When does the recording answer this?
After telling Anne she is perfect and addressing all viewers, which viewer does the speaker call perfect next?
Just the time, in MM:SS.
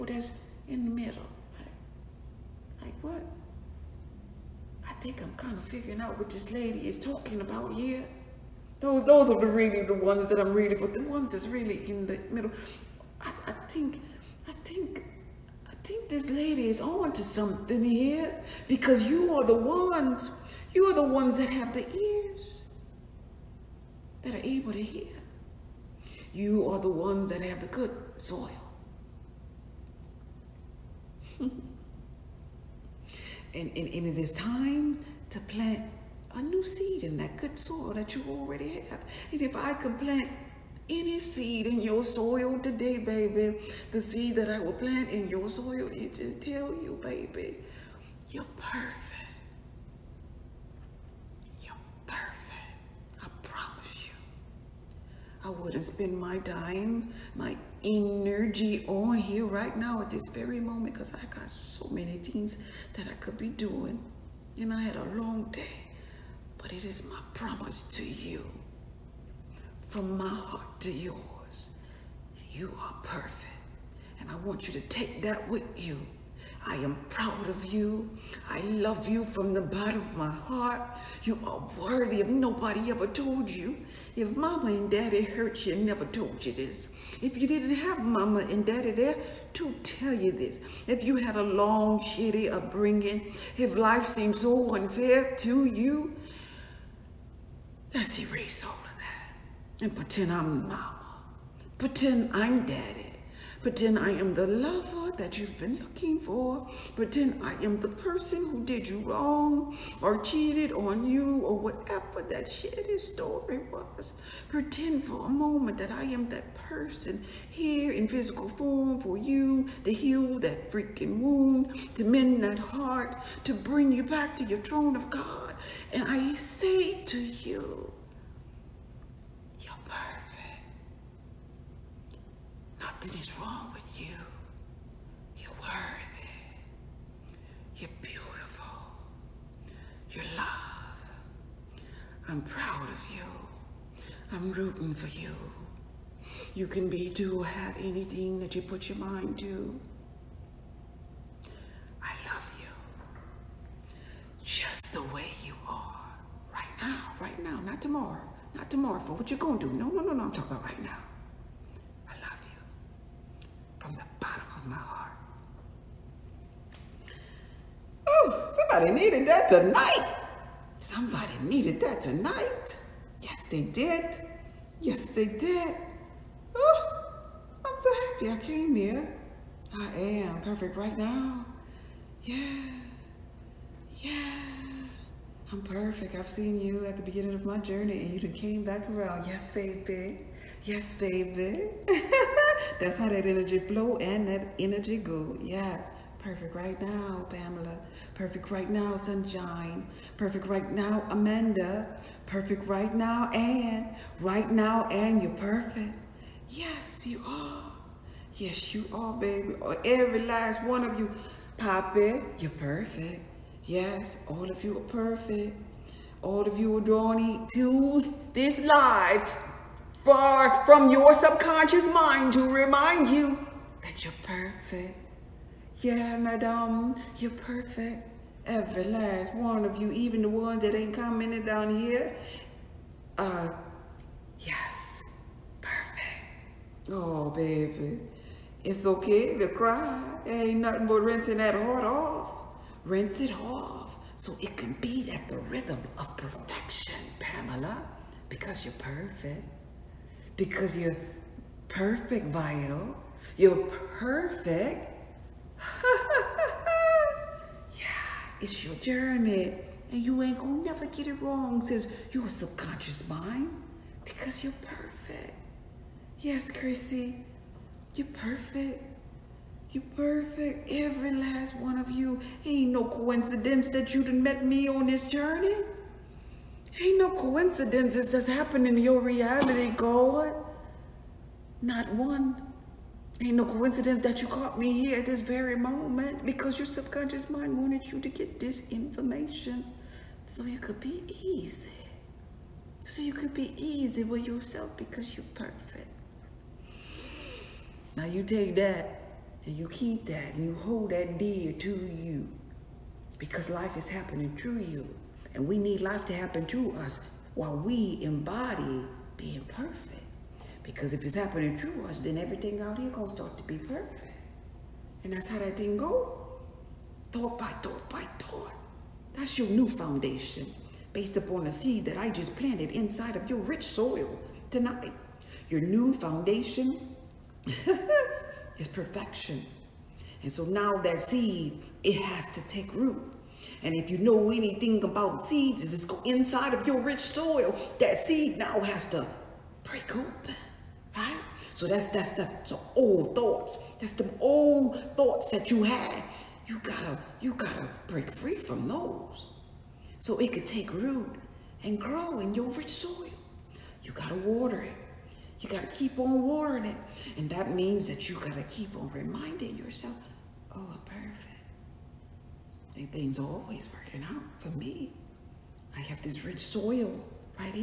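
03:31.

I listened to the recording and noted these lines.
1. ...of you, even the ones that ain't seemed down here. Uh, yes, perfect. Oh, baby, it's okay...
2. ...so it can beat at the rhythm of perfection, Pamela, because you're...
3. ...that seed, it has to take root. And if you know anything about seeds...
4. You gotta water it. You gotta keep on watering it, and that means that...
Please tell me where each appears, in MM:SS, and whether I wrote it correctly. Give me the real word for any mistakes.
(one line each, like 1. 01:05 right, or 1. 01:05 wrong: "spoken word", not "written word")
1. 03:49 wrong: "commented", not "seemed"
2. 04:04 right
3. 05:30 right
4. 05:53 right.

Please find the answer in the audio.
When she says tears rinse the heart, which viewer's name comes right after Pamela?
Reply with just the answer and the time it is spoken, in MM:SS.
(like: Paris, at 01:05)
Vital, at 04:12.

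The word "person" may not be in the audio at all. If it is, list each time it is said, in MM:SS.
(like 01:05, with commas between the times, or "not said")
01:47, 01:56.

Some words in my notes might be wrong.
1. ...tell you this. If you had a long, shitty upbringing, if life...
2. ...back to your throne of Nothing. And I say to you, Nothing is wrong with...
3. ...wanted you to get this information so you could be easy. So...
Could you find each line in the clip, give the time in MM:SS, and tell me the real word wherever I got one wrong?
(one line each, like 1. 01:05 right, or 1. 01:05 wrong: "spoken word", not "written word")
1. 01:29 right
2. 02:04 wrong: "God", not "Nothing"
3. 04:47 right.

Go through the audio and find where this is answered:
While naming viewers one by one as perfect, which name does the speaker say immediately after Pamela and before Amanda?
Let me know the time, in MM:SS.
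03:18.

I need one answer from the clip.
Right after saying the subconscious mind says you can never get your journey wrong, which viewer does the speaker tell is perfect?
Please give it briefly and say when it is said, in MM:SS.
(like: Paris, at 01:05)
Chrissy, at 04:26.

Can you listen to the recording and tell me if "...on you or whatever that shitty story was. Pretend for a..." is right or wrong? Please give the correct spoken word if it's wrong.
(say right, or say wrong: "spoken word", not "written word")
right.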